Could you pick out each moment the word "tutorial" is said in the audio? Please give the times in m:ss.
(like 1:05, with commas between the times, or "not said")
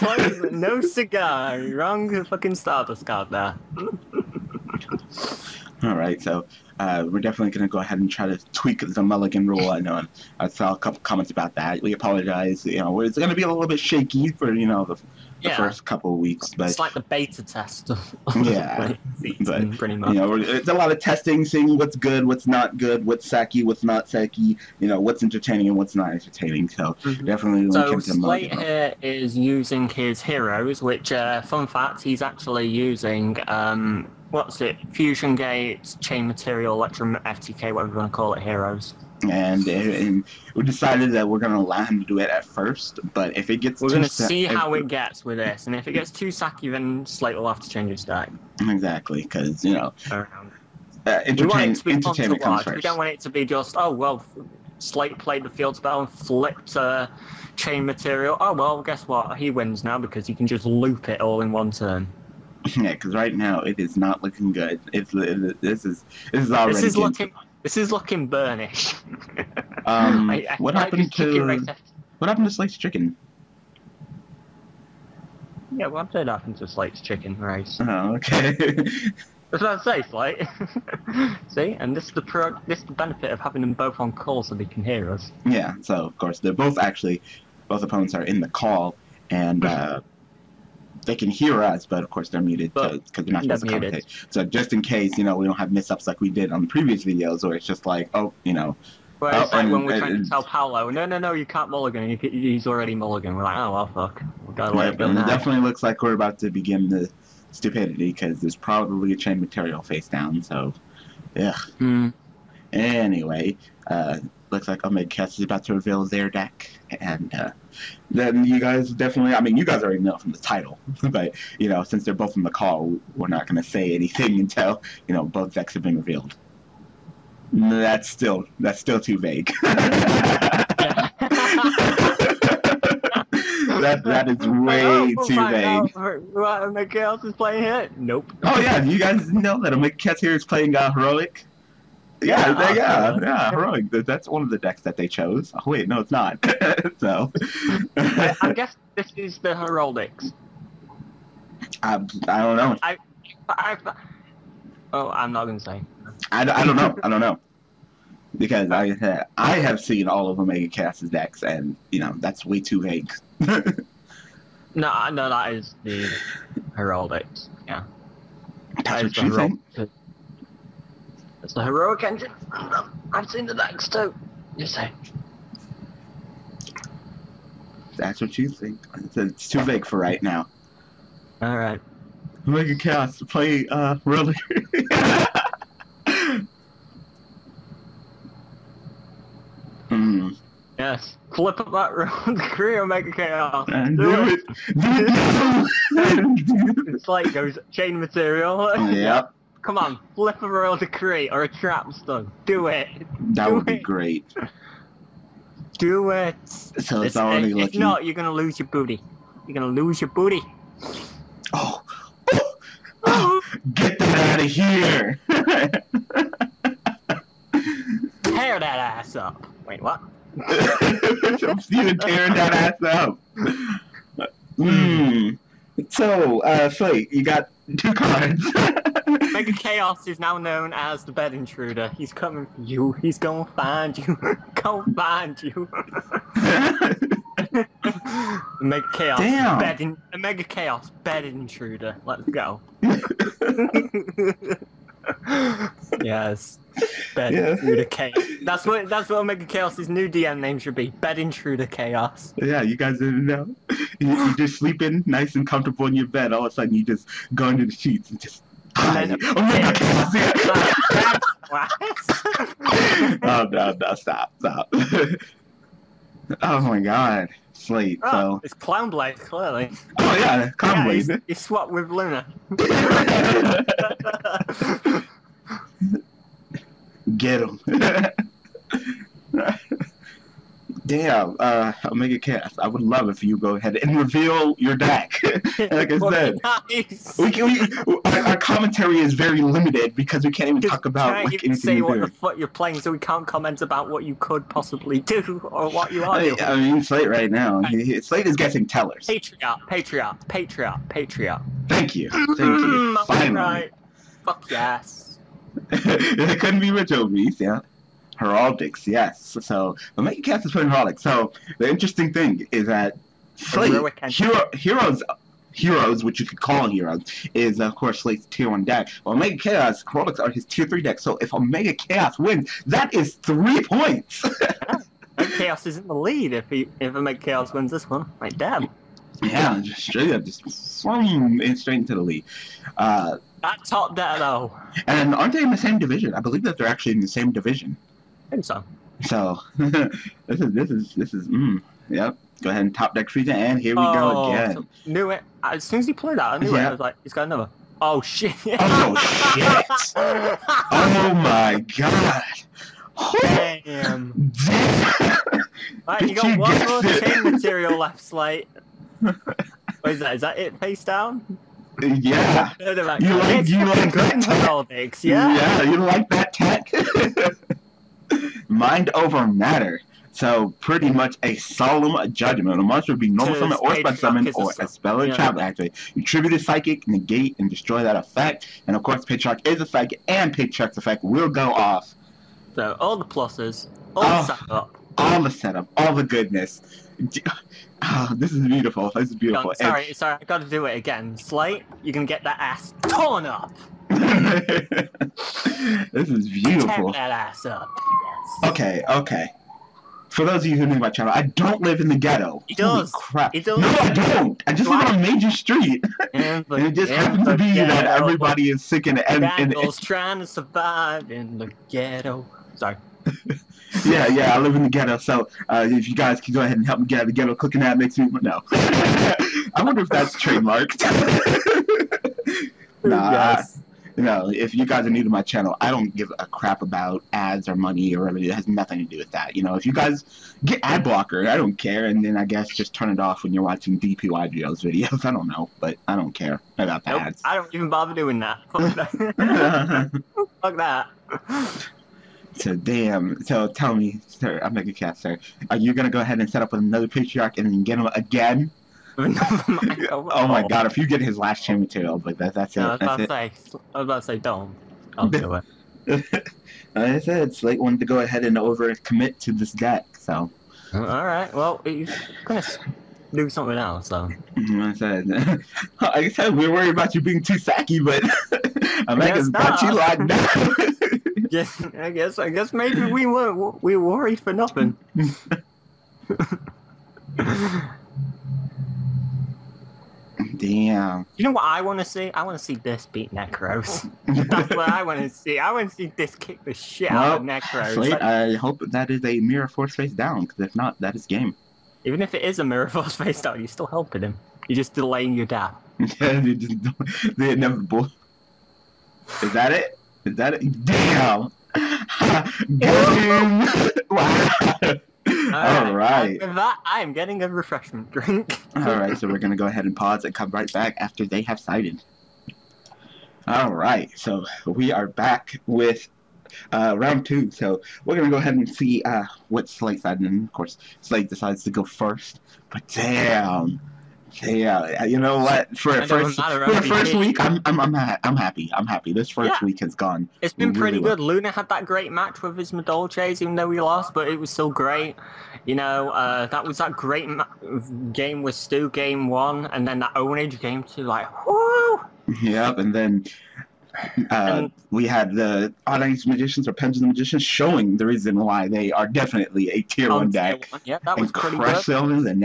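not said.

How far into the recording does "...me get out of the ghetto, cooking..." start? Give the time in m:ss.
6:56.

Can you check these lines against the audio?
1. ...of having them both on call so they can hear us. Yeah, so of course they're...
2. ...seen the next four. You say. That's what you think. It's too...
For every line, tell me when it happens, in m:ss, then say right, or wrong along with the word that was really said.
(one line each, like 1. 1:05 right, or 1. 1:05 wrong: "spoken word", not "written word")
1. 1:23 right
2. 2:53 wrong: "two", not "four".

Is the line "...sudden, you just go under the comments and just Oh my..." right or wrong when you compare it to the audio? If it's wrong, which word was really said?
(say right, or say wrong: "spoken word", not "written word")
wrong: "sheets", not "comments".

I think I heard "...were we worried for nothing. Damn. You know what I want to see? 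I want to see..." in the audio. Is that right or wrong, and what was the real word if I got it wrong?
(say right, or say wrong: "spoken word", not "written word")
right.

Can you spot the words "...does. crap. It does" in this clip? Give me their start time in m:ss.
6:42.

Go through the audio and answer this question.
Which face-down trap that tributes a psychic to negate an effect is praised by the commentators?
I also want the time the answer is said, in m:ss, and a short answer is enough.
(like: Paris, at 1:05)
Mind over Matter, at 6:08.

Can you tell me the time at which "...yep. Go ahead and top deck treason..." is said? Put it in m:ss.
5:41.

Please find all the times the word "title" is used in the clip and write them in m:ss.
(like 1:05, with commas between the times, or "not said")
2:00.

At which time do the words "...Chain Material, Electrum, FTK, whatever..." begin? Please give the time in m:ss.
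0:36.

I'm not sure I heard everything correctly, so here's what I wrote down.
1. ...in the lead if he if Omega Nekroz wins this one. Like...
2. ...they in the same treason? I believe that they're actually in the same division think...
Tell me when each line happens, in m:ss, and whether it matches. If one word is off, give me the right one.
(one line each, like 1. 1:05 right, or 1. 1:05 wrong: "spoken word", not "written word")
1. 5:25 wrong: "Chaos", not "Nekroz"
2. 5:35 wrong: "division", not "treason".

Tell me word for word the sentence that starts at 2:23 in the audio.
That's one of the decks that they chose.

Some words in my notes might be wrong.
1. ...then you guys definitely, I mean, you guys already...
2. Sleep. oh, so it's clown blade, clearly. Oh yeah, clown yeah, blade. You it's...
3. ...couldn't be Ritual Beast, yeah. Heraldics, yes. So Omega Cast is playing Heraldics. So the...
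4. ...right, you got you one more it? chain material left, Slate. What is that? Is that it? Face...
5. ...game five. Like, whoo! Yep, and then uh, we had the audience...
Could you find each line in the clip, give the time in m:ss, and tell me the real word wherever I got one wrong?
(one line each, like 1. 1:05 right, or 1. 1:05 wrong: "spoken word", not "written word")
1. 1:58 right
2. 4:27 right
3. 5:06 right
4. 5:55 right
5. 9:00 wrong: "two", not "five".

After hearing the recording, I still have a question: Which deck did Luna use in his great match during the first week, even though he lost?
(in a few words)
Madolches.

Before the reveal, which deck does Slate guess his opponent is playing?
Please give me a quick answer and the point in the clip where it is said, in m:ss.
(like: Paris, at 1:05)
Tellars, at 4:58.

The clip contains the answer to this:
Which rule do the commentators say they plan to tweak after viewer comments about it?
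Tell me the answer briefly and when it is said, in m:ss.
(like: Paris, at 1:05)
Mulligan rule, at 0:09.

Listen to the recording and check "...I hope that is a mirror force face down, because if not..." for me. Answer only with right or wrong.
right.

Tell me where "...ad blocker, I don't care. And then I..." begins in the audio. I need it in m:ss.
7:10.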